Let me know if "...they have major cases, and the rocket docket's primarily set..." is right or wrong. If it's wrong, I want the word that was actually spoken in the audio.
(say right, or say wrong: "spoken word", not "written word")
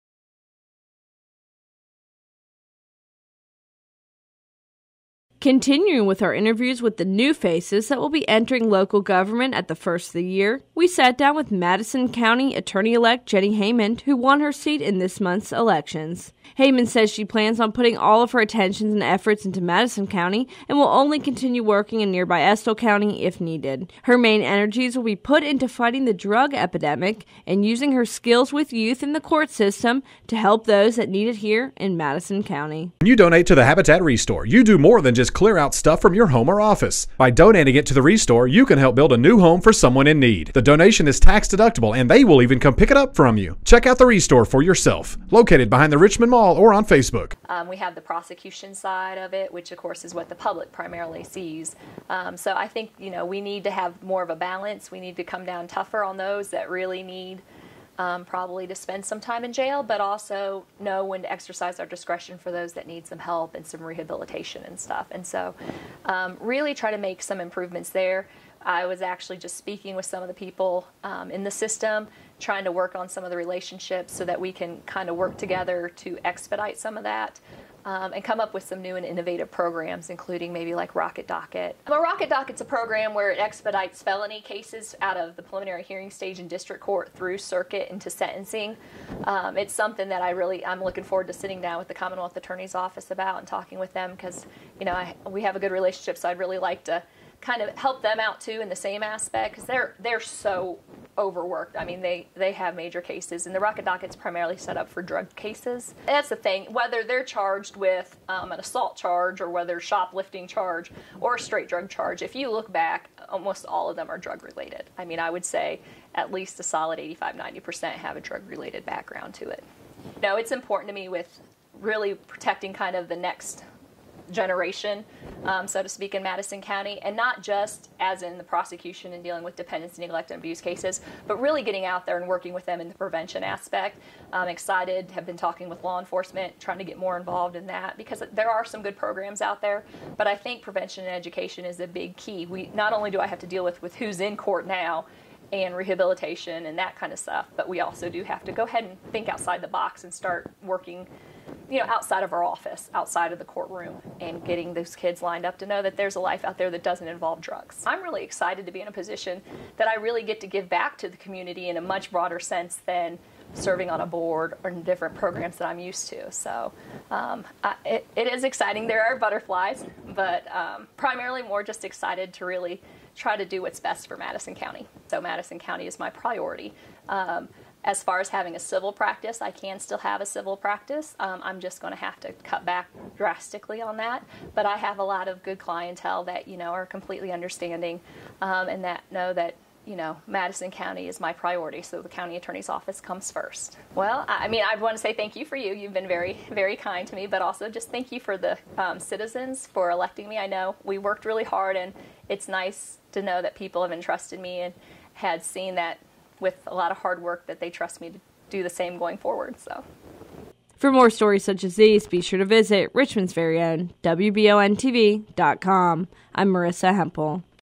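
right.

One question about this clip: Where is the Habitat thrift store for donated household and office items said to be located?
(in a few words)
Behind the Richmond Mall.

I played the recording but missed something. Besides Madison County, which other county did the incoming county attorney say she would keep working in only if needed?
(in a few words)
Estill County.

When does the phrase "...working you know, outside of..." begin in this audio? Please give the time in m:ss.
2:30.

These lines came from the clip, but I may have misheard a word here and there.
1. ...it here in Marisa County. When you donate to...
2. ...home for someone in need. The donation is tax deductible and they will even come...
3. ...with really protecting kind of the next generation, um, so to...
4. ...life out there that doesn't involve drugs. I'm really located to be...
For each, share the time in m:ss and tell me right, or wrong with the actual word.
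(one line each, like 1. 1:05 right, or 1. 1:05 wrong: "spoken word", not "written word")
1. 0:31 wrong: "Madison", not "Marisa"
2. 0:39 right
3. 2:01 right
4. 2:36 wrong: "excited", not "located".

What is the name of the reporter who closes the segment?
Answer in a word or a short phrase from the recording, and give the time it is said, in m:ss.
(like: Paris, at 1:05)
Marisa Hempel, at 3:36.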